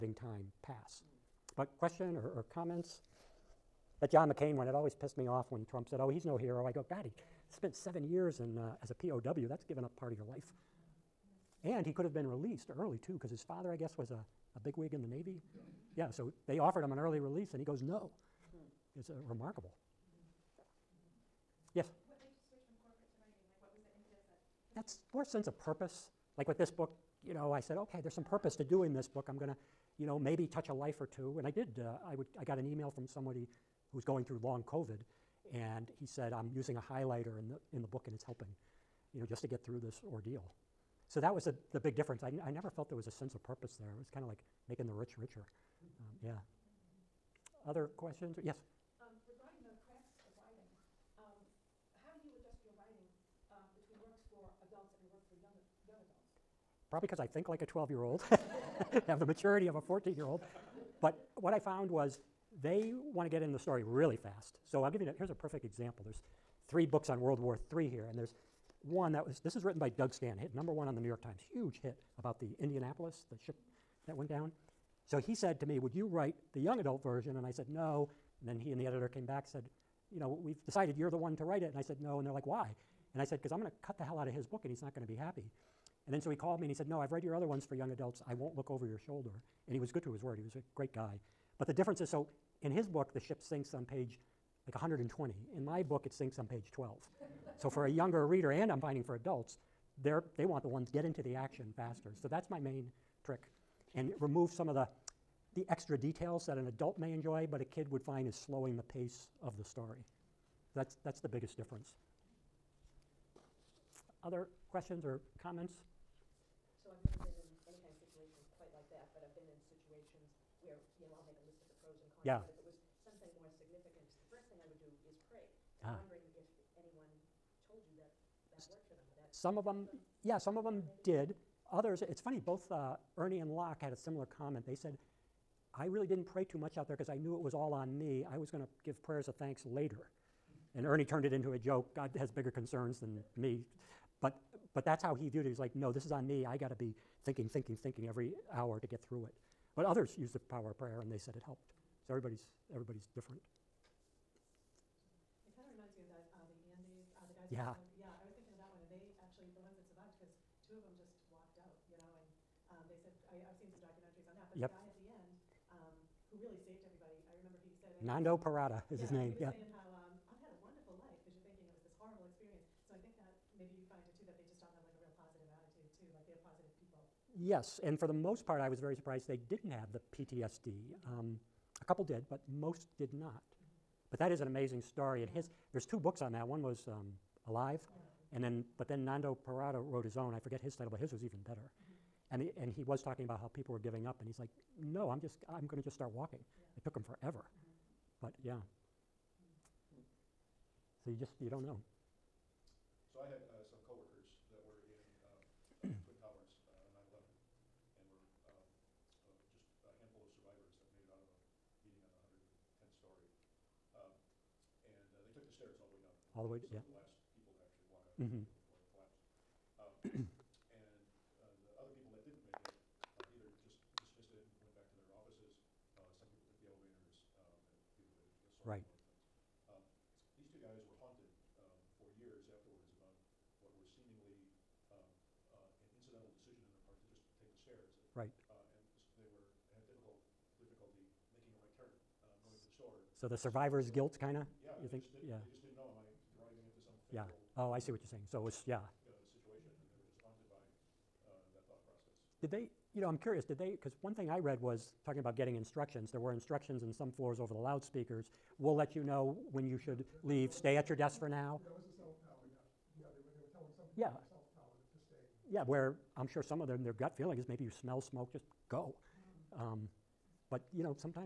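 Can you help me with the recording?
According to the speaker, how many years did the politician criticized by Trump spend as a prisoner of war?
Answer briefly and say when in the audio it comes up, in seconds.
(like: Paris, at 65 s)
7, at 7 s.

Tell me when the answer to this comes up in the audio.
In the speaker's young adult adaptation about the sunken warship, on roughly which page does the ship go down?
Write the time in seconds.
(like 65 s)
96 s.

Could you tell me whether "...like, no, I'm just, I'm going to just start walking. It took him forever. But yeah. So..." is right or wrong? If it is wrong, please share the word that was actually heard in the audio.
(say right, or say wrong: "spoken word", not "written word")
right.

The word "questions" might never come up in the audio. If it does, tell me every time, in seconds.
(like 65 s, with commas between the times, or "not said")
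1 s, 47 s, 114 s.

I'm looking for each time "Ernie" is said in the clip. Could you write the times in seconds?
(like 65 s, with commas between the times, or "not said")
133 s, 140 s.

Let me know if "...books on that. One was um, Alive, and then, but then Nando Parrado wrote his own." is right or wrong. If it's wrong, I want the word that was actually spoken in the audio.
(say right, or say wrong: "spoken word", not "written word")
right.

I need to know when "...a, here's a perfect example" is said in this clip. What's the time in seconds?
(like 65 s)
65 s.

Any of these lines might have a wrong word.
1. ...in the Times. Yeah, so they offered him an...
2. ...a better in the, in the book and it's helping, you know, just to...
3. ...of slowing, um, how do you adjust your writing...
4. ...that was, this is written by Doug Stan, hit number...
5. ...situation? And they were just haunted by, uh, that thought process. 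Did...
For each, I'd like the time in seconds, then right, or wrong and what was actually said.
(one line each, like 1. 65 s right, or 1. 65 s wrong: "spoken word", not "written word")
1. 14 s wrong: "Navy", not "Times"
2. 36 s wrong: "highlighter", not "better"
3. 49 s wrong: "writing", not "slowing"
4. 69 s right
5. 249 s right.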